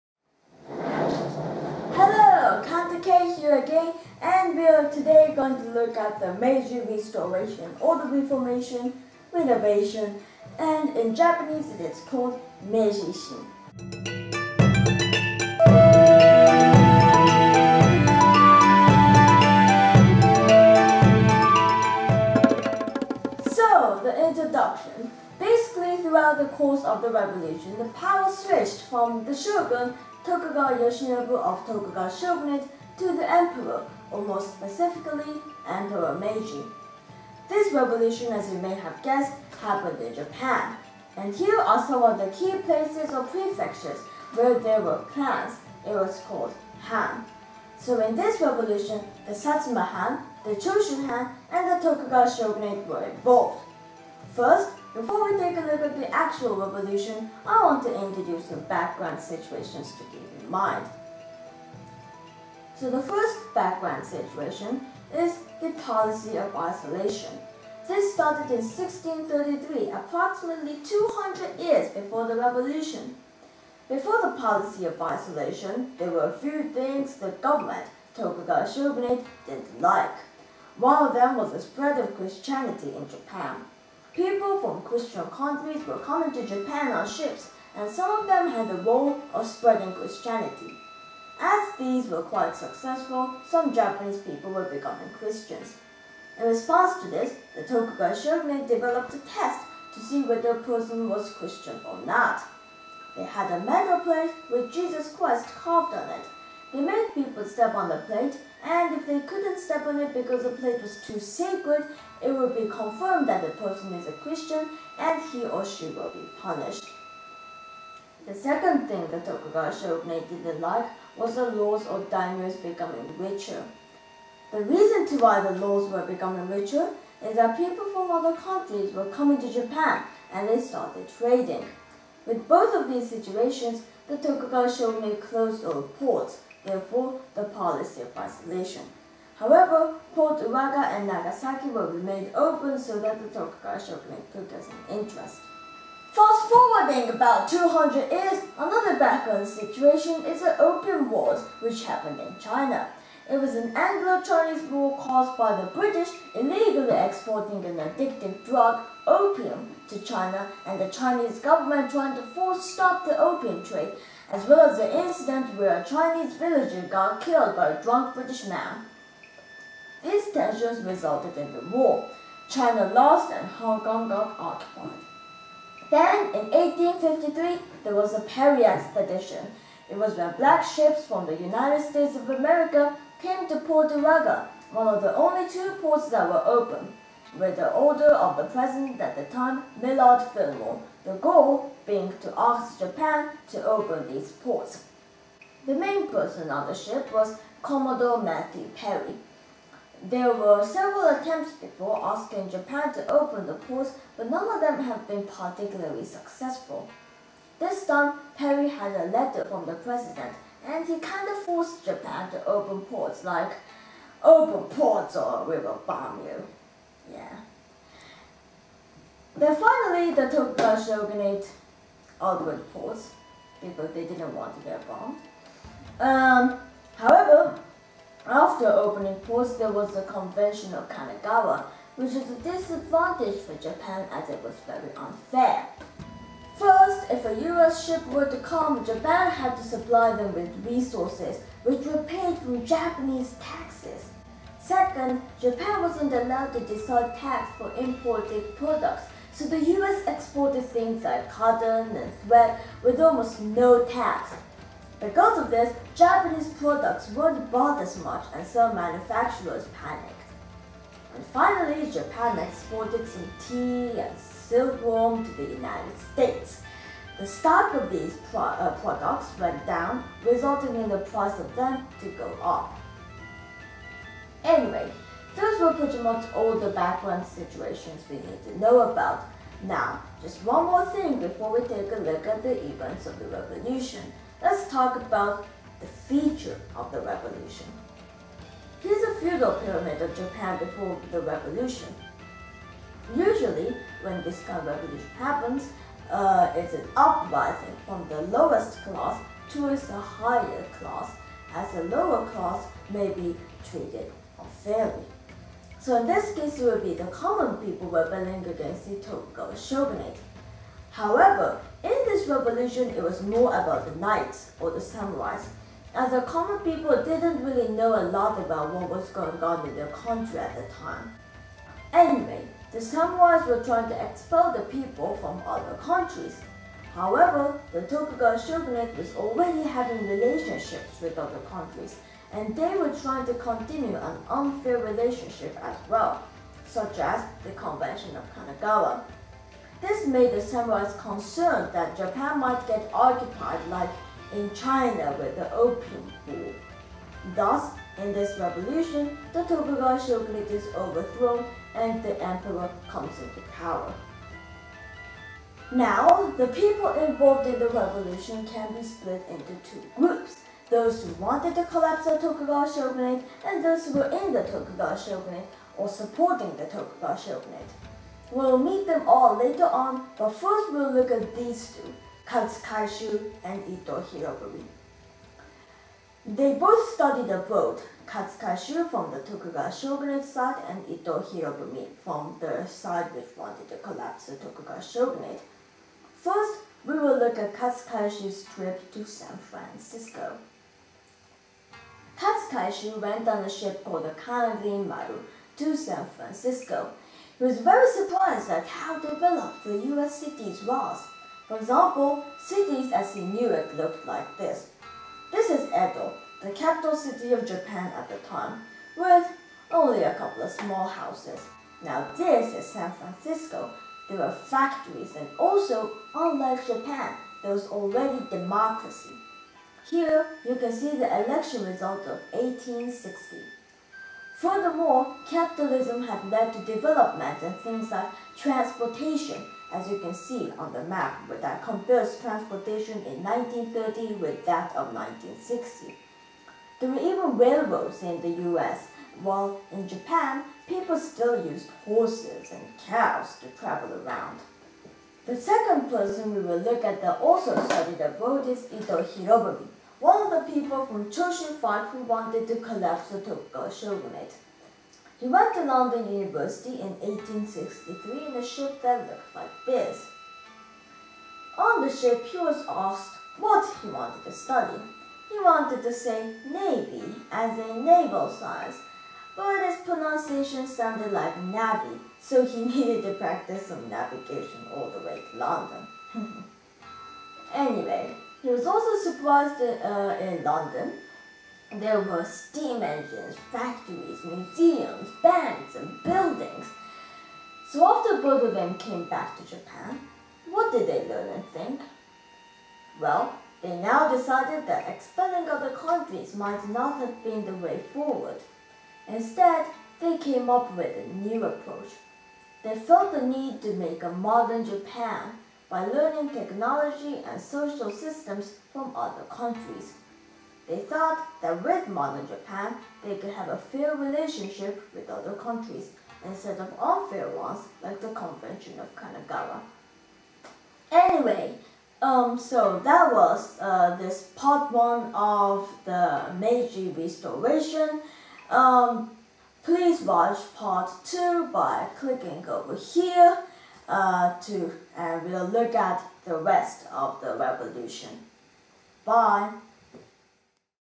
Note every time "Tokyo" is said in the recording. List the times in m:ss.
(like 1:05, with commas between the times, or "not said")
7:33.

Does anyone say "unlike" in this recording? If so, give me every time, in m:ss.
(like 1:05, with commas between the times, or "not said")
6:56.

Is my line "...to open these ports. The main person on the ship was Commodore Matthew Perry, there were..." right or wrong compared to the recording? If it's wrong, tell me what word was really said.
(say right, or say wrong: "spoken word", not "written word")
right.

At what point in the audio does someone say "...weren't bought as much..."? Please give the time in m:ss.
4:17.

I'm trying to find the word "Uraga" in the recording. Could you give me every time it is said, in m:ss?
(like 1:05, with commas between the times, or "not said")
2:20, 3:03.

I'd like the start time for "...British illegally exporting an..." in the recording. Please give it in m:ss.
2:35.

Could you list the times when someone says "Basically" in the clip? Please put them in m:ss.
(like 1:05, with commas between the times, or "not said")
0:25.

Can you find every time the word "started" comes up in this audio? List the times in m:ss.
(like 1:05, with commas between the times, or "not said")
1:08, 2:10.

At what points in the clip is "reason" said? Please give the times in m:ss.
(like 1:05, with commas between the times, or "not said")
2:04.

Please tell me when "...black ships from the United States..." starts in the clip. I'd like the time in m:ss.
3:00.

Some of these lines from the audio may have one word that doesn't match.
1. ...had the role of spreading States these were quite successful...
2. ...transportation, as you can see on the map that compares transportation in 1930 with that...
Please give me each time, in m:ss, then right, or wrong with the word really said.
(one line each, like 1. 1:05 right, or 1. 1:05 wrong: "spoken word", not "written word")
1. 1:28 wrong: "Christianity", not "States"
2. 7:08 right.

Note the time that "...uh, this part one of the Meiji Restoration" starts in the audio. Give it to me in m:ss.
8:43.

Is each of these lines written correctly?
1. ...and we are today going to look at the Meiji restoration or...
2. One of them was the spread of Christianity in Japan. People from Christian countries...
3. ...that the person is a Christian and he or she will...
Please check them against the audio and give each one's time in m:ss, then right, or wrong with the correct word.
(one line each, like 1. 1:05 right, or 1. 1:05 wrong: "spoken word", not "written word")
1. 0:04 right
2. 1:20 right
3. 1:53 right.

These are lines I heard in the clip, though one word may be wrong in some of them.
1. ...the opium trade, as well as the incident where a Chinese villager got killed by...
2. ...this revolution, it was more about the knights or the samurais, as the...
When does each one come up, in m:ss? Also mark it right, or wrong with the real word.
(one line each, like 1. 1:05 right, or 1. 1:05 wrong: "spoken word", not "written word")
1. 2:43 right
2. 5:12 right.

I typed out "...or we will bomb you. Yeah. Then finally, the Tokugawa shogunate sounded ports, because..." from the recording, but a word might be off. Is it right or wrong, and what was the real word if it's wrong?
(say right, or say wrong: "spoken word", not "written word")
wrong: "opened", not "sounded".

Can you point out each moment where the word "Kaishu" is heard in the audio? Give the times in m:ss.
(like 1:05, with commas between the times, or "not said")
6:12, 6:18, 6:27, 6:32.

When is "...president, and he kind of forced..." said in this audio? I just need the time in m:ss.
3:29.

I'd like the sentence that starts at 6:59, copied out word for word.
Here, you can see the election result of 1860.